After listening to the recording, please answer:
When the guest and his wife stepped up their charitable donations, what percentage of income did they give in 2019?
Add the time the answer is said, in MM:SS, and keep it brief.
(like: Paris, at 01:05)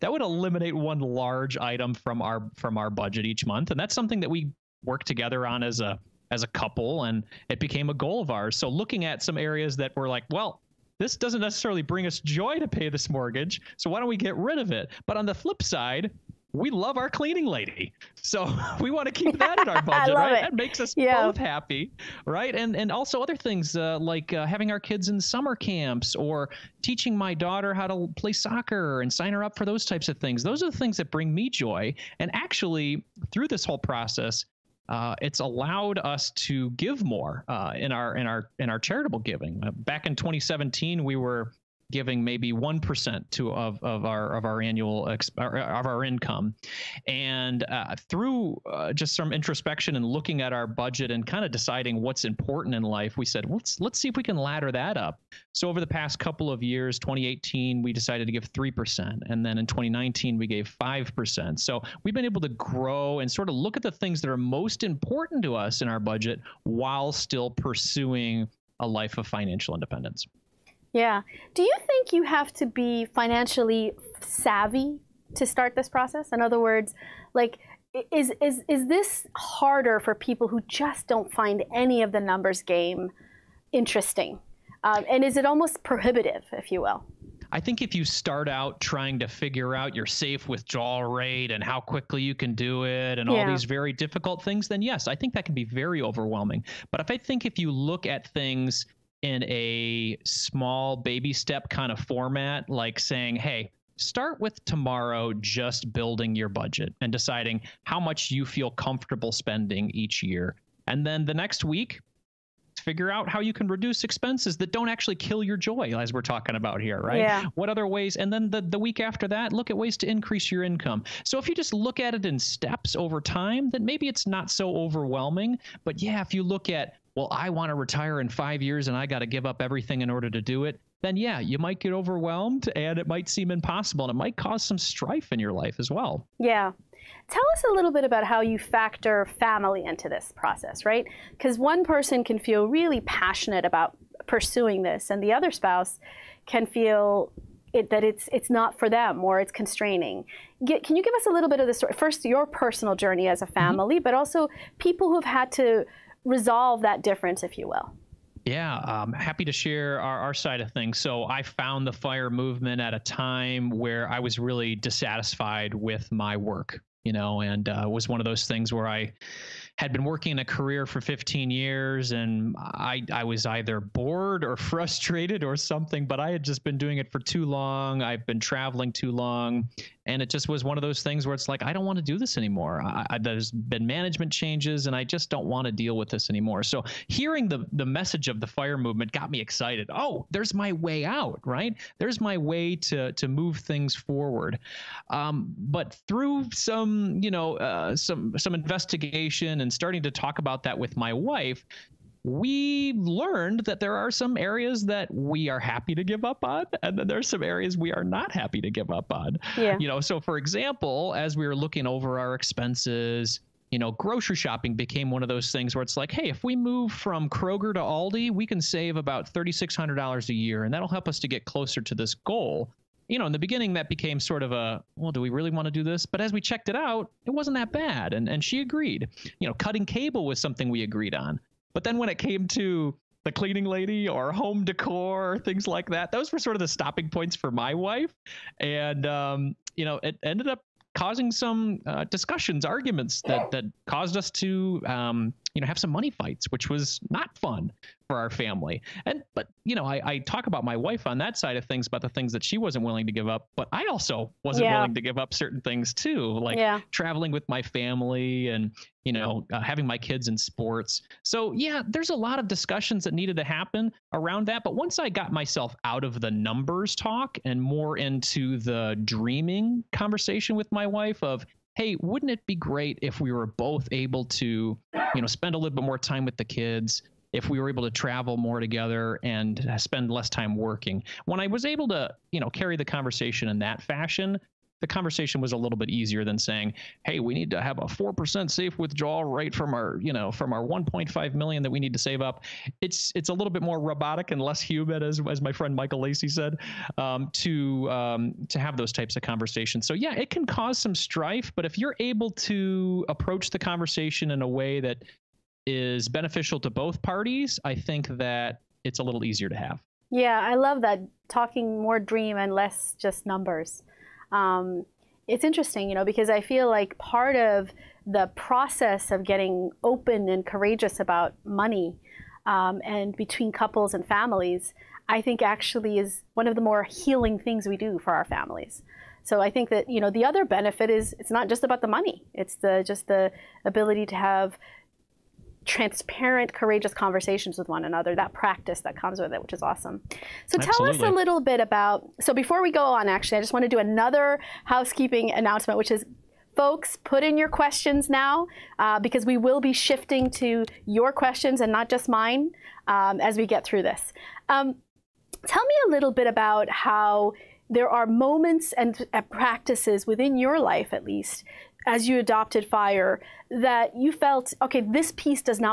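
5%, at 01:00.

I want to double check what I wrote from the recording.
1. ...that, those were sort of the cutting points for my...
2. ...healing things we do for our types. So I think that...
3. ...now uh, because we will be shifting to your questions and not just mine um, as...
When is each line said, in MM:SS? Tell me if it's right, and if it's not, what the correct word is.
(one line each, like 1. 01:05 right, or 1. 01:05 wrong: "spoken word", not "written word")
1. 03:55 wrong: "stopping", not "cutting"
2. 05:26 wrong: "families", not "types"
3. 05:48 right.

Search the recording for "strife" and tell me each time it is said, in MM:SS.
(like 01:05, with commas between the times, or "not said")
02:14, 05:00.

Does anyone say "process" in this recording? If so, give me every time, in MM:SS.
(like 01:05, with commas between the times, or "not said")
00:33, 01:15, 02:20, 05:18.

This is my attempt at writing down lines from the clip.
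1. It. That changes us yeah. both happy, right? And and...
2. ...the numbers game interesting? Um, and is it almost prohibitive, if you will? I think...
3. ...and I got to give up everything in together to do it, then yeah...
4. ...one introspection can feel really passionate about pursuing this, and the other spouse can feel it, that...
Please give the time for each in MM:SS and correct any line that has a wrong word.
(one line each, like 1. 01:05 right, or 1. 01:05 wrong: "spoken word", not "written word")
1. 00:20 wrong: "makes", not "changes"
2. 01:22 right
3. 02:08 wrong: "order", not "together"
4. 02:21 wrong: "person", not "introspection".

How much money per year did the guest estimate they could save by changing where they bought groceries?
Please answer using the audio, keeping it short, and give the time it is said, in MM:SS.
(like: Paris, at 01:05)
$3,600, at 03:39.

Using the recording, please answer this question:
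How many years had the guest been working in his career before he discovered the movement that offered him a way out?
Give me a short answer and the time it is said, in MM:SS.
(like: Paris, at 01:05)
15, at 02:51.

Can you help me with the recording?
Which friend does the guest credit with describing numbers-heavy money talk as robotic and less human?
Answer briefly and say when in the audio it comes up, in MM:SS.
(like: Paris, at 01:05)
Michael Lacey, at 04:55.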